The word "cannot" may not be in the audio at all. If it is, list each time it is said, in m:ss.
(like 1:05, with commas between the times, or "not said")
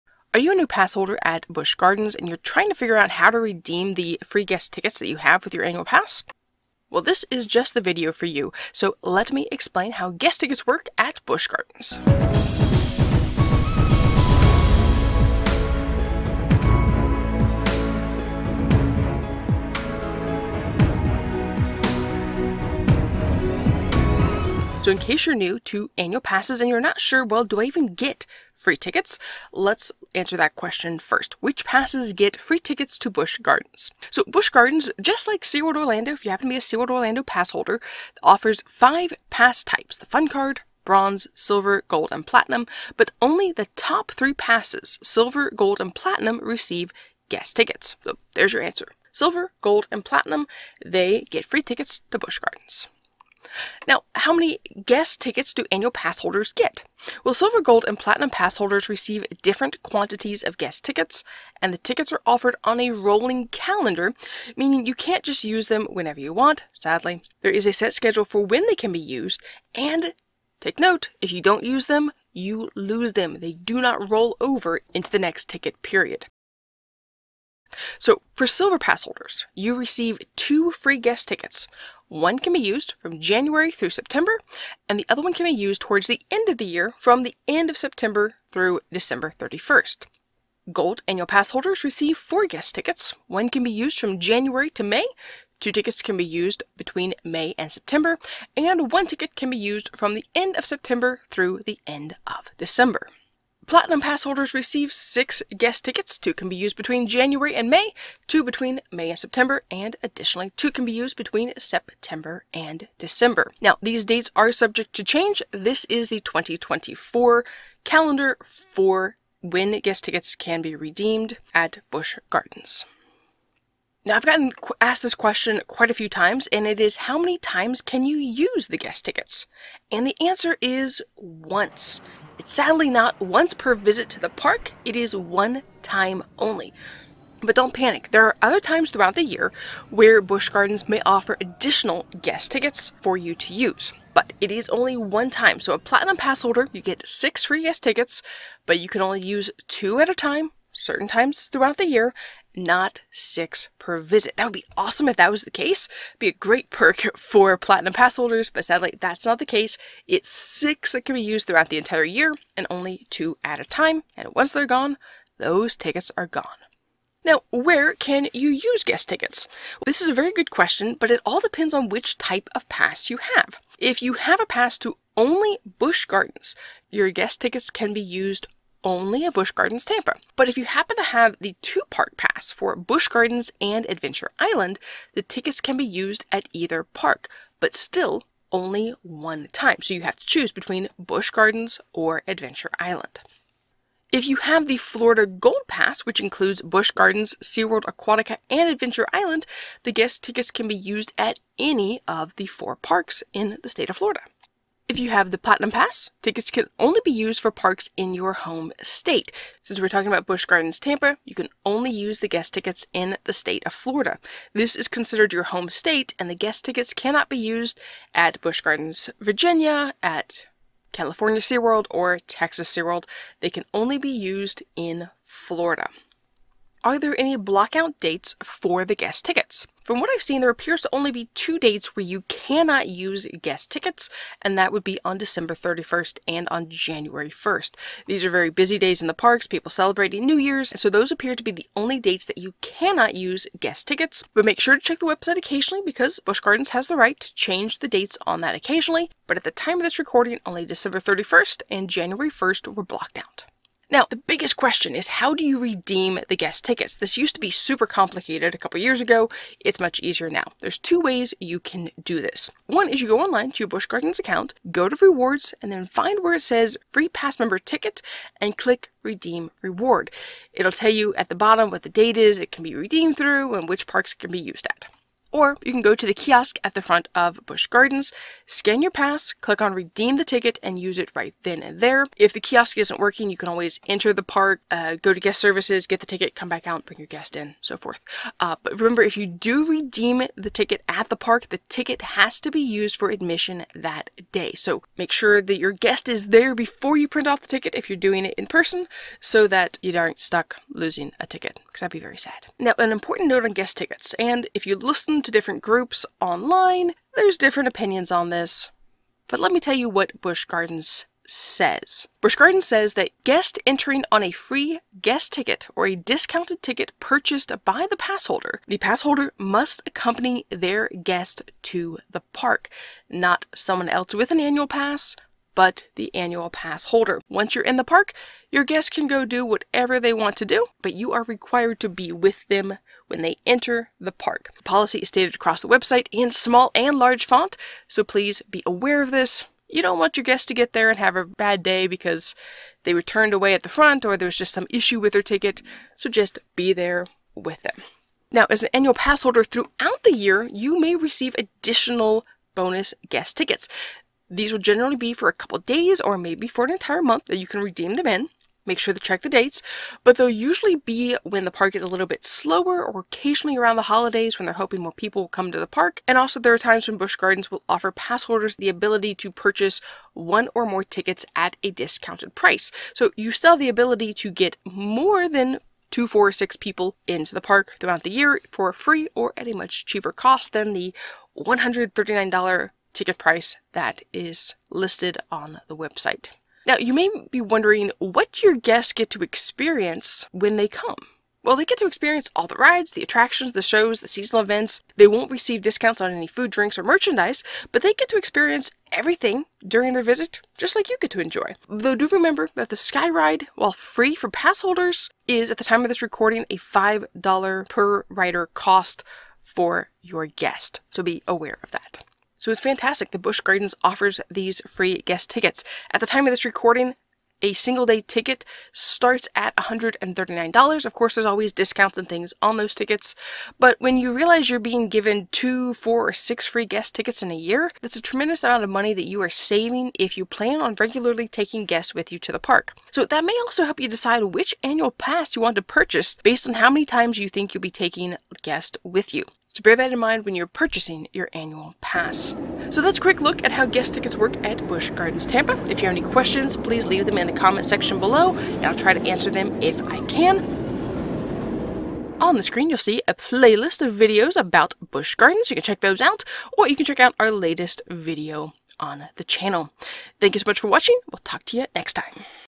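3:36, 3:52, 4:02.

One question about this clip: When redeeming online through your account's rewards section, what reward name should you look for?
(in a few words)
Free pass member ticket.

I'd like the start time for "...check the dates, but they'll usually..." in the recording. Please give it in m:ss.
5:58.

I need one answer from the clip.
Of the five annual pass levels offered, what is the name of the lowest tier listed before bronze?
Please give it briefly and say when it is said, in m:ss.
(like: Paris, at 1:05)
Fun card, at 0:39.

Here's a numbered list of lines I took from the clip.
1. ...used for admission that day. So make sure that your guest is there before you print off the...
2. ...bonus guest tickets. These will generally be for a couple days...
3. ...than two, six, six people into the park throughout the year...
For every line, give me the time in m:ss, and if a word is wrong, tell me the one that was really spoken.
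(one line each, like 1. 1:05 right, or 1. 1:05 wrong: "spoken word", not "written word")
1. 4:52 right
2. 5:52 right
3. 6:15 wrong: "four", not "six".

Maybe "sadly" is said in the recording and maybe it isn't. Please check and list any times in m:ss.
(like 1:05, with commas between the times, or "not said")
1:06, 2:12, 2:38.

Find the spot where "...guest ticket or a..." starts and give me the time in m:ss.
5:15.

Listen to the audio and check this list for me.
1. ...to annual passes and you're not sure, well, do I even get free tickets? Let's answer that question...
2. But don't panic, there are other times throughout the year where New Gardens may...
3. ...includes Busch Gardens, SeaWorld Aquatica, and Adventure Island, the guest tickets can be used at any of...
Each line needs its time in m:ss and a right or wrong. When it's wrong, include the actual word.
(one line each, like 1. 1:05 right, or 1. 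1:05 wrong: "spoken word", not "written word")
1. 0:25 right
2. 2:17 wrong: "Busch", not "New"
3. 3:16 right.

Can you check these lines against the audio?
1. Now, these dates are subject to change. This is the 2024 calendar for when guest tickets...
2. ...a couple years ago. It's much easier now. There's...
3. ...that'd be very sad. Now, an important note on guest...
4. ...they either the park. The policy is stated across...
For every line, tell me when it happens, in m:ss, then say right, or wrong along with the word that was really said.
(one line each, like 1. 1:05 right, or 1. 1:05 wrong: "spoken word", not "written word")
1. 1:53 right
2. 4:18 right
3. 5:01 right
4. 5:33 wrong: "enter", not "either".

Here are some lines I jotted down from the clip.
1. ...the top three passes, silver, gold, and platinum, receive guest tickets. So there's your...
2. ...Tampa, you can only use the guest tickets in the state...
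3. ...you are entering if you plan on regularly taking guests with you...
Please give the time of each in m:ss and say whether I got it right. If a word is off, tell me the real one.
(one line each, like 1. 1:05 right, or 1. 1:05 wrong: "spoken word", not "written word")
1. 0:43 right
2. 3:30 right
3. 7:09 wrong: "saving", not "entering".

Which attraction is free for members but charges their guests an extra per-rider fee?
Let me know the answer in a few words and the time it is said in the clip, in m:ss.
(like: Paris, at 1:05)
Sky Ride, at 6:42.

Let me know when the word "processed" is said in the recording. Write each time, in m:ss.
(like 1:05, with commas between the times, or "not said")
not said.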